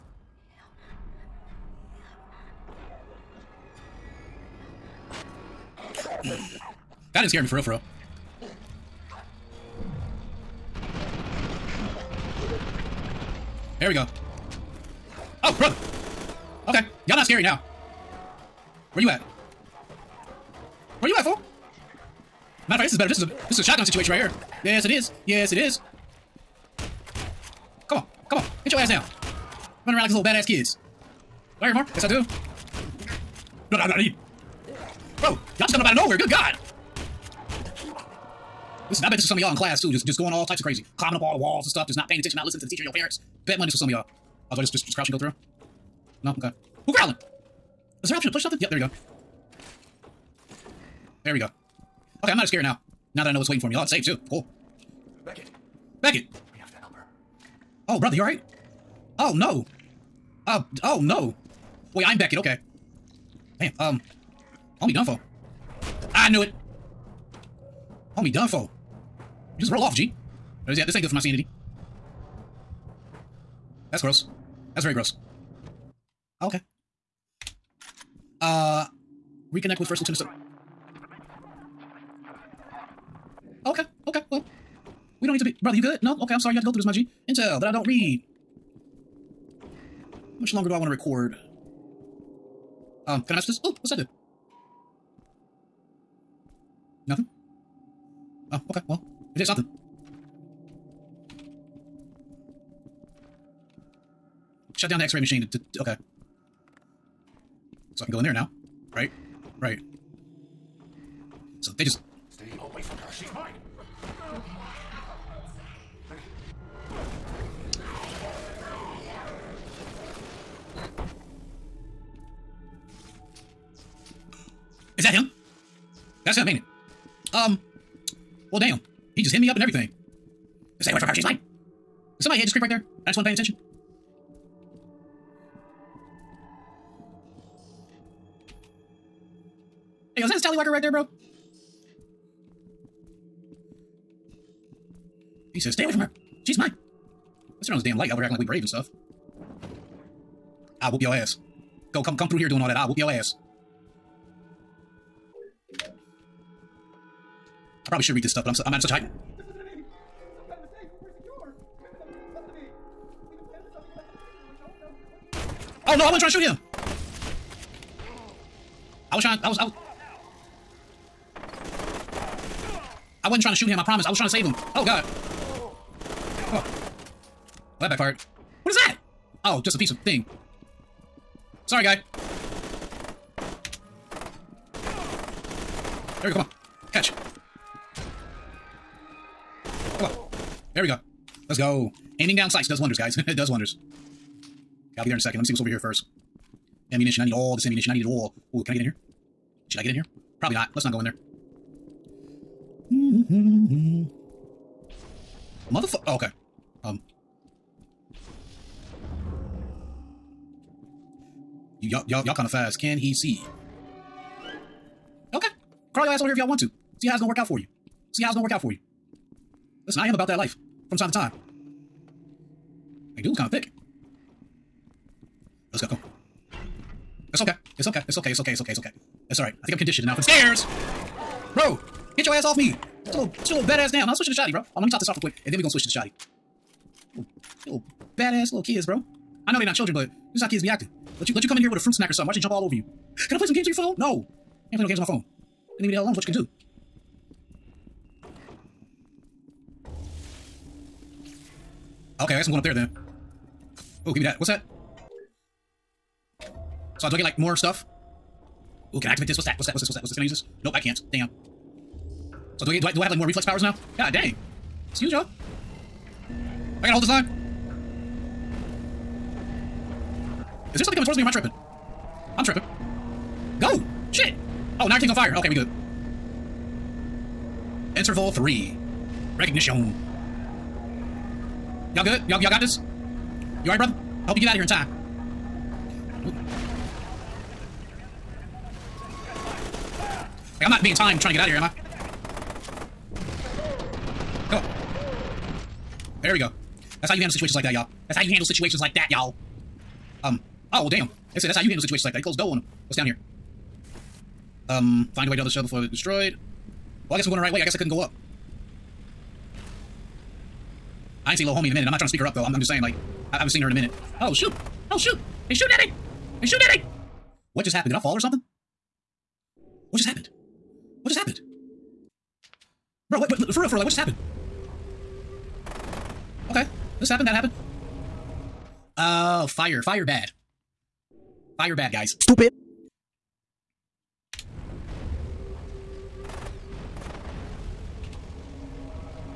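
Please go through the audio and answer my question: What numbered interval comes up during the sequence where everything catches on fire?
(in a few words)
Interval 3.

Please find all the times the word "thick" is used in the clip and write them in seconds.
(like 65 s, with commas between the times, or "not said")
223 s.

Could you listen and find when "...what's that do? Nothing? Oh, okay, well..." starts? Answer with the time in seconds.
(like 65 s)
93 s.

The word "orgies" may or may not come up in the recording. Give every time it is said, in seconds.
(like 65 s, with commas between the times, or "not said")
not said.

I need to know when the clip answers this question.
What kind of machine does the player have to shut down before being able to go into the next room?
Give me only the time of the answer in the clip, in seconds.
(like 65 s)
105 s.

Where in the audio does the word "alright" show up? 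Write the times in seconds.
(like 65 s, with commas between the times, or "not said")
58 s, 283 s.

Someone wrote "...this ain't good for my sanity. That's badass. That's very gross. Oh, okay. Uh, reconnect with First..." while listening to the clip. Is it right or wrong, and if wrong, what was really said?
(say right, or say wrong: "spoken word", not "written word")
wrong: "gross", not "badass".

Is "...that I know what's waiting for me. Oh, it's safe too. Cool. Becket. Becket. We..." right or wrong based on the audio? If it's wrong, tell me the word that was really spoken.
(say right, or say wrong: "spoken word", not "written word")
right.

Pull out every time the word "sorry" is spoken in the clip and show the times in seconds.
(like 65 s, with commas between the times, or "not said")
86 s, 181 s.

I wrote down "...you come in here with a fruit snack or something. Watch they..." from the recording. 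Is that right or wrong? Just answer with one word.
right.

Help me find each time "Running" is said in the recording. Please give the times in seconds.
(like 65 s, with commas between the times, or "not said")
29 s.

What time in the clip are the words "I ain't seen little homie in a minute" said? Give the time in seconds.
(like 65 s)
311 s.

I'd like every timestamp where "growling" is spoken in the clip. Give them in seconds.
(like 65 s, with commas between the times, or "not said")
46 s.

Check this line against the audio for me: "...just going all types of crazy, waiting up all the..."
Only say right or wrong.
wrong.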